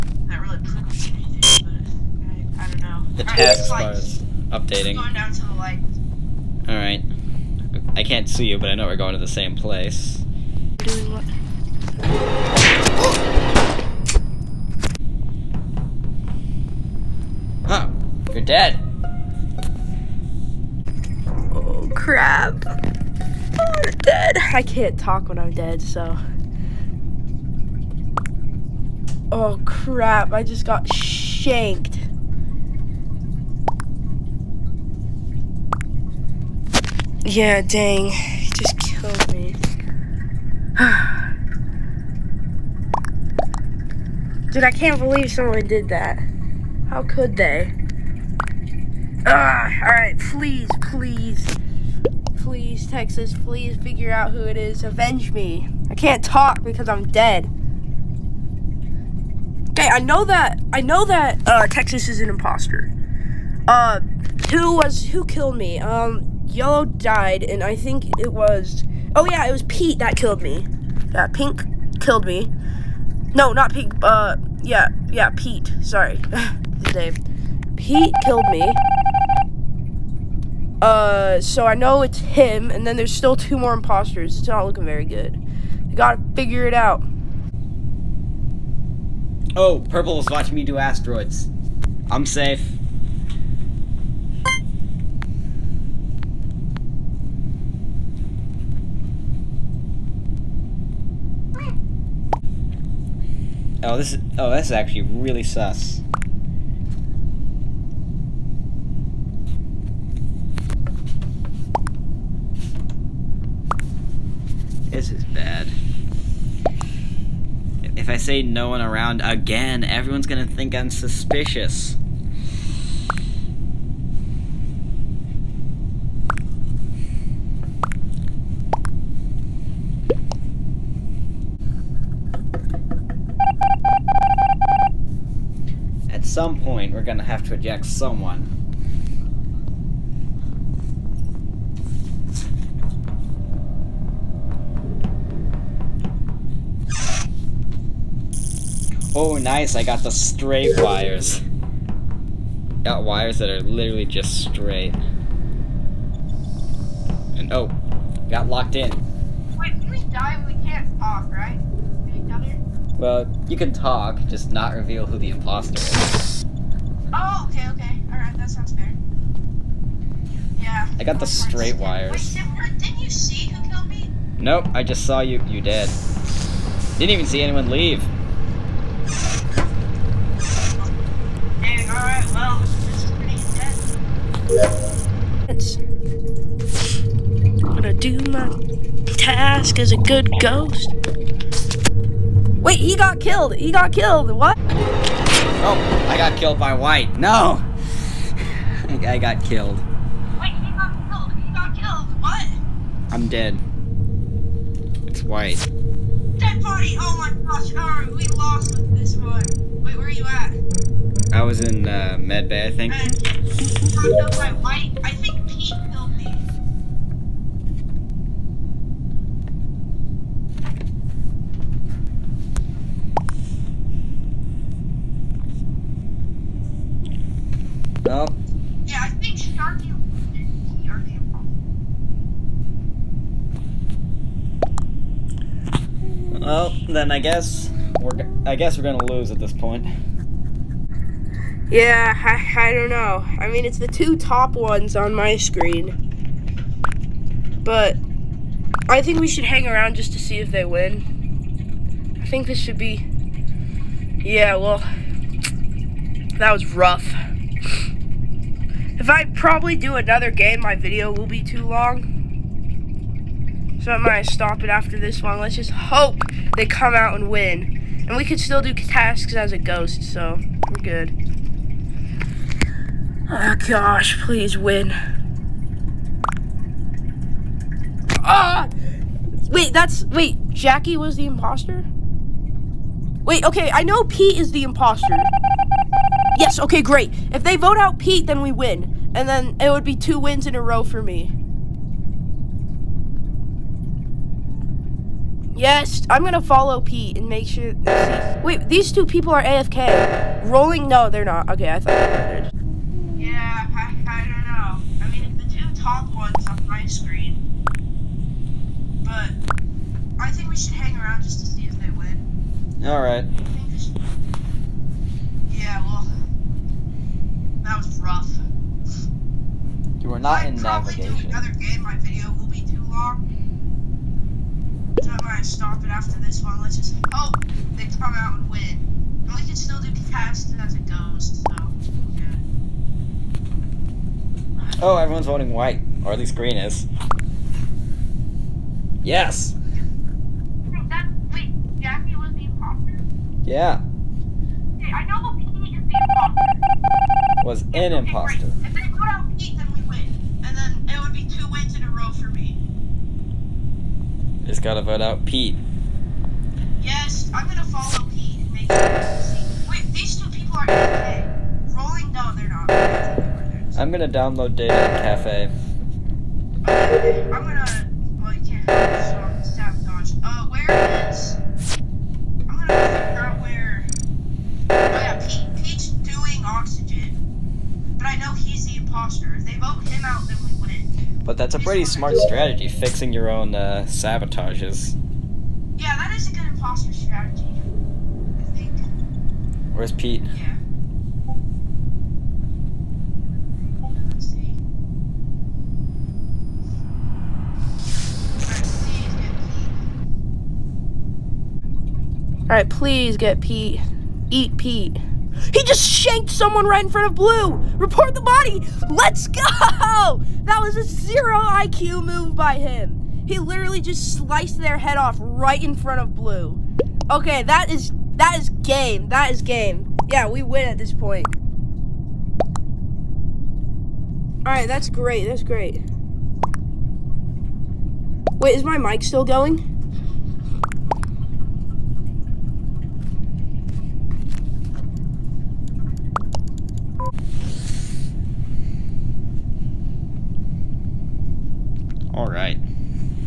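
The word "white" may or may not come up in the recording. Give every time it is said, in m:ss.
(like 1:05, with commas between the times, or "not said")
3:16, 3:25, 3:34, 5:35.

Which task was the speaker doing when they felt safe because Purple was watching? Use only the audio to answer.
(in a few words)
Asteroids.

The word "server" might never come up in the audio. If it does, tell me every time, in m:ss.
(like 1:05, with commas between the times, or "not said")
not said.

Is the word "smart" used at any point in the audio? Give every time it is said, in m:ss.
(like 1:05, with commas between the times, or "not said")
6:21.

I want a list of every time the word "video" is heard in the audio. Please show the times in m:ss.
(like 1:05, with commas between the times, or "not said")
4:20, 5:21.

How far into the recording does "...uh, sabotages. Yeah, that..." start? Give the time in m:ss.
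6:23.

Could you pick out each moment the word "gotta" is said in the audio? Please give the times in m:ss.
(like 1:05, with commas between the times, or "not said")
1:25, 5:54.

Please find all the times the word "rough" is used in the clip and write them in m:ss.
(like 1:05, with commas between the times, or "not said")
4:16, 5:18.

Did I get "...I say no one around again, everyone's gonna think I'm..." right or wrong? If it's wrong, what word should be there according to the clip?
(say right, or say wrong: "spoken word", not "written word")
right.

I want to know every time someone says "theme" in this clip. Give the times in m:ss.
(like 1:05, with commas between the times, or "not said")
not said.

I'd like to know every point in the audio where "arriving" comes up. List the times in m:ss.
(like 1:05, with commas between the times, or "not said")
not said.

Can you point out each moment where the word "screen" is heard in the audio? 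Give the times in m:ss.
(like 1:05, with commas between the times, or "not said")
4:05, 5:06.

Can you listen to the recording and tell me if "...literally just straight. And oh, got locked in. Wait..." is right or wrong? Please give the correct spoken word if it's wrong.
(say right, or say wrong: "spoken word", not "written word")
right.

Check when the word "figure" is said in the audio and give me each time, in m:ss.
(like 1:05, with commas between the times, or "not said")
0:53, 1:26.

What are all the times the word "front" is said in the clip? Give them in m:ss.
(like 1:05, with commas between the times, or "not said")
6:46, 6:55.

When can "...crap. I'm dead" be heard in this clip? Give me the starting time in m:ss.
0:21.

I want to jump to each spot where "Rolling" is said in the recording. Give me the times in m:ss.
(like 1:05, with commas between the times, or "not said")
5:00, 6:01.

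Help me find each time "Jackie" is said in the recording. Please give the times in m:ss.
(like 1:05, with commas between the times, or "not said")
4:40, 5:41.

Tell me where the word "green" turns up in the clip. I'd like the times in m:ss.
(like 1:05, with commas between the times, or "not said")
5:36.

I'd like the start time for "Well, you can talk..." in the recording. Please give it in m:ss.
2:42.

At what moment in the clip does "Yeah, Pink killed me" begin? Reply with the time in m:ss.
1:11.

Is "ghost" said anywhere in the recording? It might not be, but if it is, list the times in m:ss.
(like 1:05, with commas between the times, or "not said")
3:10, 4:29.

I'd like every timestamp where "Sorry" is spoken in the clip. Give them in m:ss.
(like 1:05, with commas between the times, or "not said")
1:15.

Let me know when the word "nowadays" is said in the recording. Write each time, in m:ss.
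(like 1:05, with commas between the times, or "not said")
not said.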